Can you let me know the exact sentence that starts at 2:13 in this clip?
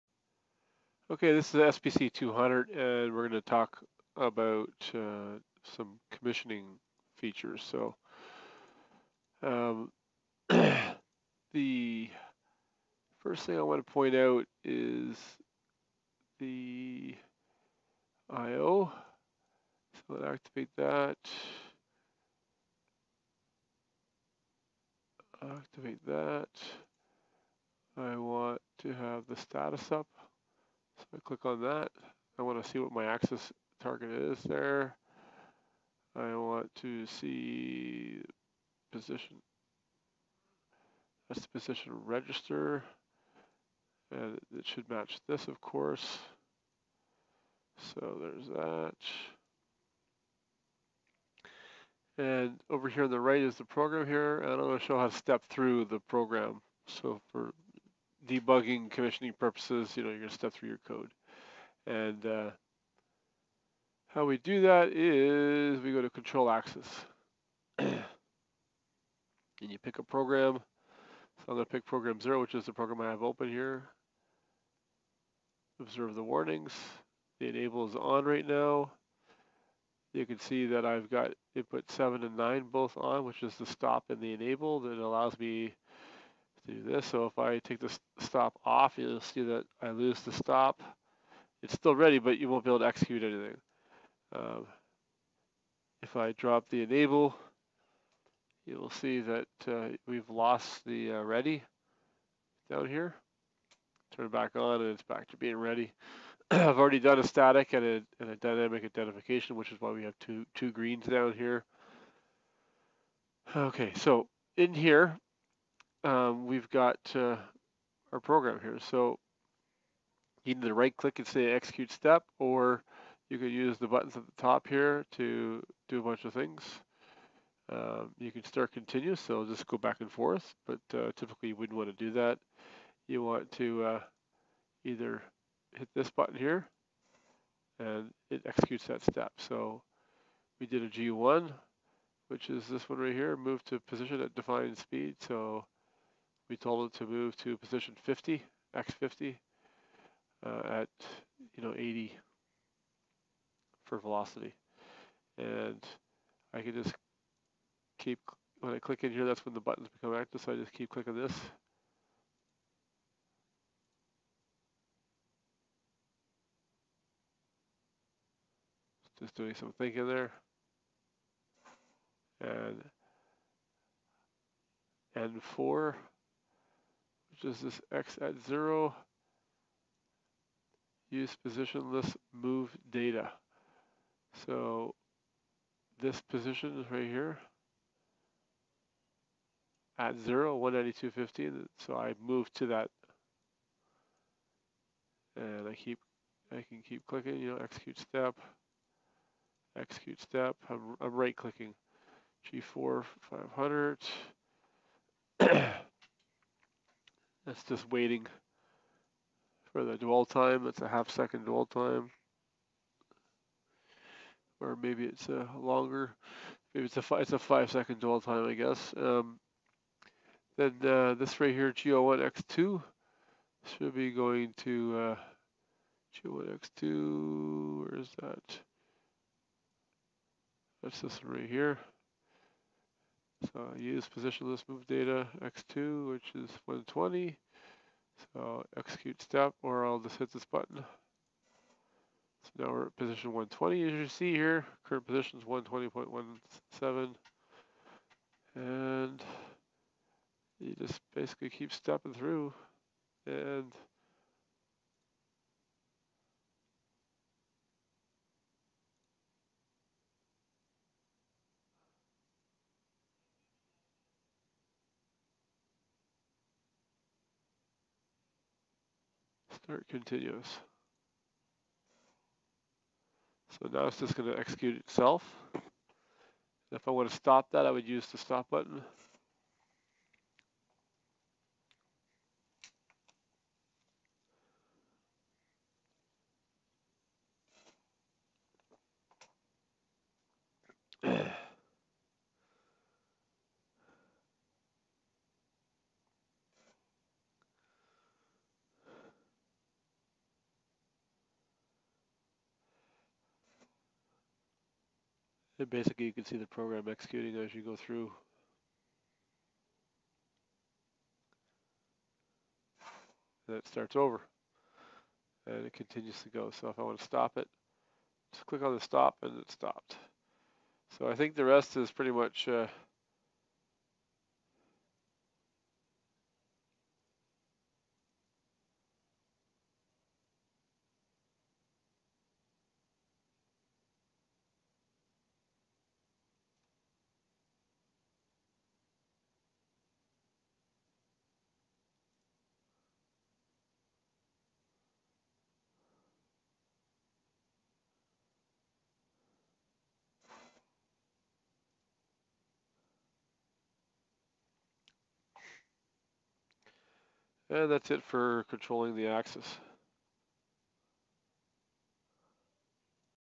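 You want to uh, either hit this button here, and it executes that step.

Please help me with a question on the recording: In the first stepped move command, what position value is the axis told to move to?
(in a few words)
50.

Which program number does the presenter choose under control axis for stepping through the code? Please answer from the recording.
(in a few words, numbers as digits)
0.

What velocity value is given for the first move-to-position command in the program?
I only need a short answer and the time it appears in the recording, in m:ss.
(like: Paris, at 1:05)
80, at 2:31.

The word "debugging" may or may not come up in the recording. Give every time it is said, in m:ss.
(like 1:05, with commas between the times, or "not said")
0:58.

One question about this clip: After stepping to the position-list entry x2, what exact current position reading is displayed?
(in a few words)
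120.17.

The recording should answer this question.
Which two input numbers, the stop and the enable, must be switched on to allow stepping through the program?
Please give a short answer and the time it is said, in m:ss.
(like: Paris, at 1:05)
7 and 9, at 1:21.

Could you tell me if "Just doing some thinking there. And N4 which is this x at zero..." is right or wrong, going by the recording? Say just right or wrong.
right.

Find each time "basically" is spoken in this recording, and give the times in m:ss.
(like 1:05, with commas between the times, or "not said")
4:11, 5:05.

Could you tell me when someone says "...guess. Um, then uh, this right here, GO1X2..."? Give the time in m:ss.
3:38.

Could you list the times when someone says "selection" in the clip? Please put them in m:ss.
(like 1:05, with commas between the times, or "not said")
not said.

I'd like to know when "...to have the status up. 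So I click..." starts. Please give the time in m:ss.
0:28.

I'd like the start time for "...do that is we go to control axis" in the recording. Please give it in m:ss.
1:04.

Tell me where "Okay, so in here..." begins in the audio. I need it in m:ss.
1:53.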